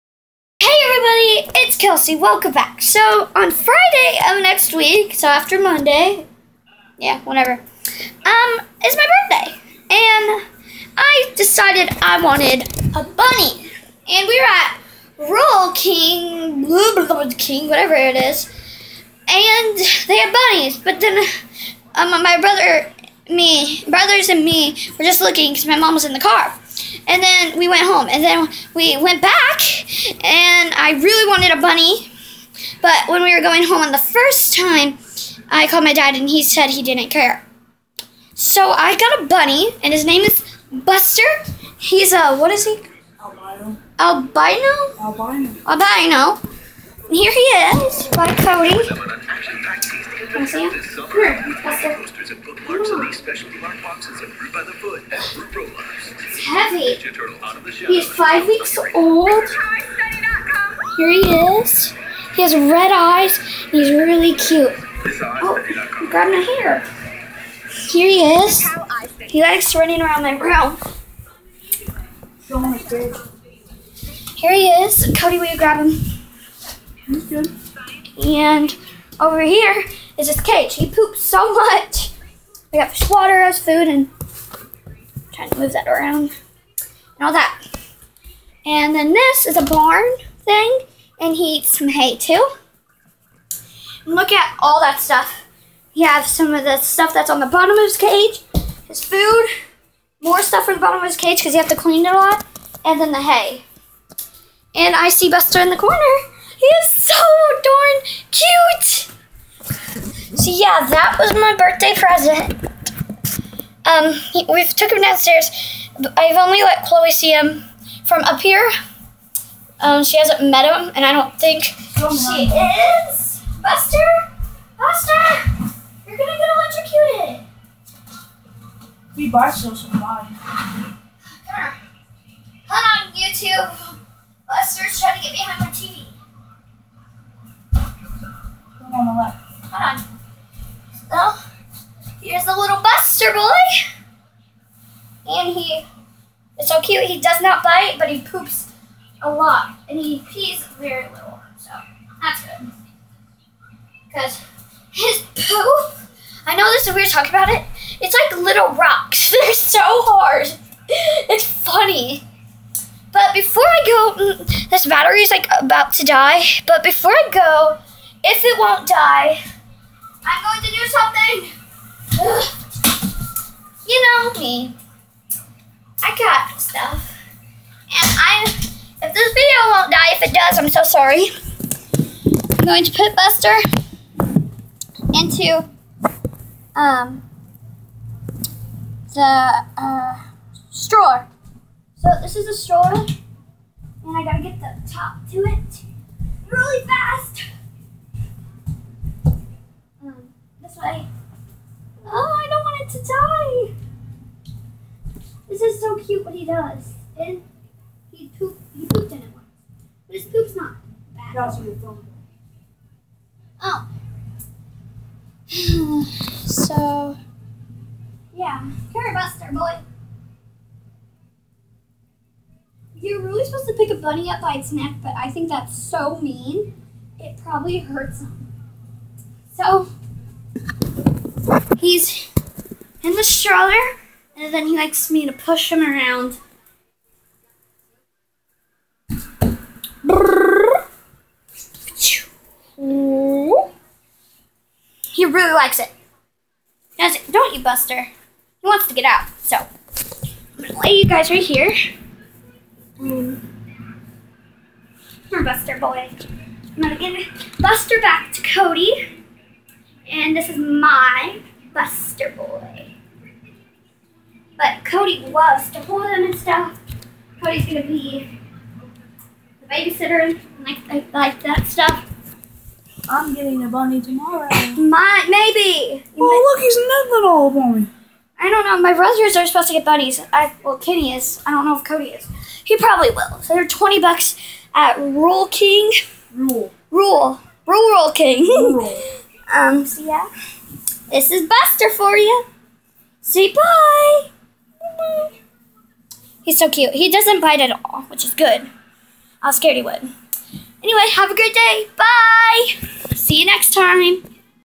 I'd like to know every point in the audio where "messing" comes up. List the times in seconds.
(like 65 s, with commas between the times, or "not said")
not said.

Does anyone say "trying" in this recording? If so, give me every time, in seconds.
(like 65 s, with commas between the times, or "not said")
85 s, 134 s.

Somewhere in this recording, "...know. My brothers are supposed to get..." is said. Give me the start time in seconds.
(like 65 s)
278 s.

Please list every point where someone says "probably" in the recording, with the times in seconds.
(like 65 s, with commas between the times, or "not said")
227 s, 282 s.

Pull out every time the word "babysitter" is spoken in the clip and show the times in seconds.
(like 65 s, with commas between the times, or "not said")
269 s.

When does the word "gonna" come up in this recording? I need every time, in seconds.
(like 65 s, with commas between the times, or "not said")
126 s, 267 s.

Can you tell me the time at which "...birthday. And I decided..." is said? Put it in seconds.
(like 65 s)
9 s.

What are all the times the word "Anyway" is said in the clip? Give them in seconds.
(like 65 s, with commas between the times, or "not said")
300 s.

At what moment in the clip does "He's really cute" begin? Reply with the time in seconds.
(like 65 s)
63 s.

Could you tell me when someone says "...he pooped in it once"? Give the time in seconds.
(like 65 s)
208 s.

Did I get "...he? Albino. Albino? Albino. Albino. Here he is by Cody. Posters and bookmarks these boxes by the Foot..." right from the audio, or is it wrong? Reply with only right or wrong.
right.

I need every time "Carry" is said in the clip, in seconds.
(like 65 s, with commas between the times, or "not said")
218 s.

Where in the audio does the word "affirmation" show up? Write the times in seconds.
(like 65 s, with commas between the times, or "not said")
not said.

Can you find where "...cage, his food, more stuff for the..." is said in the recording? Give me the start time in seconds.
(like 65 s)
97 s.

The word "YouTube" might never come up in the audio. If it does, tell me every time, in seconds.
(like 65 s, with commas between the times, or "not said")
133 s.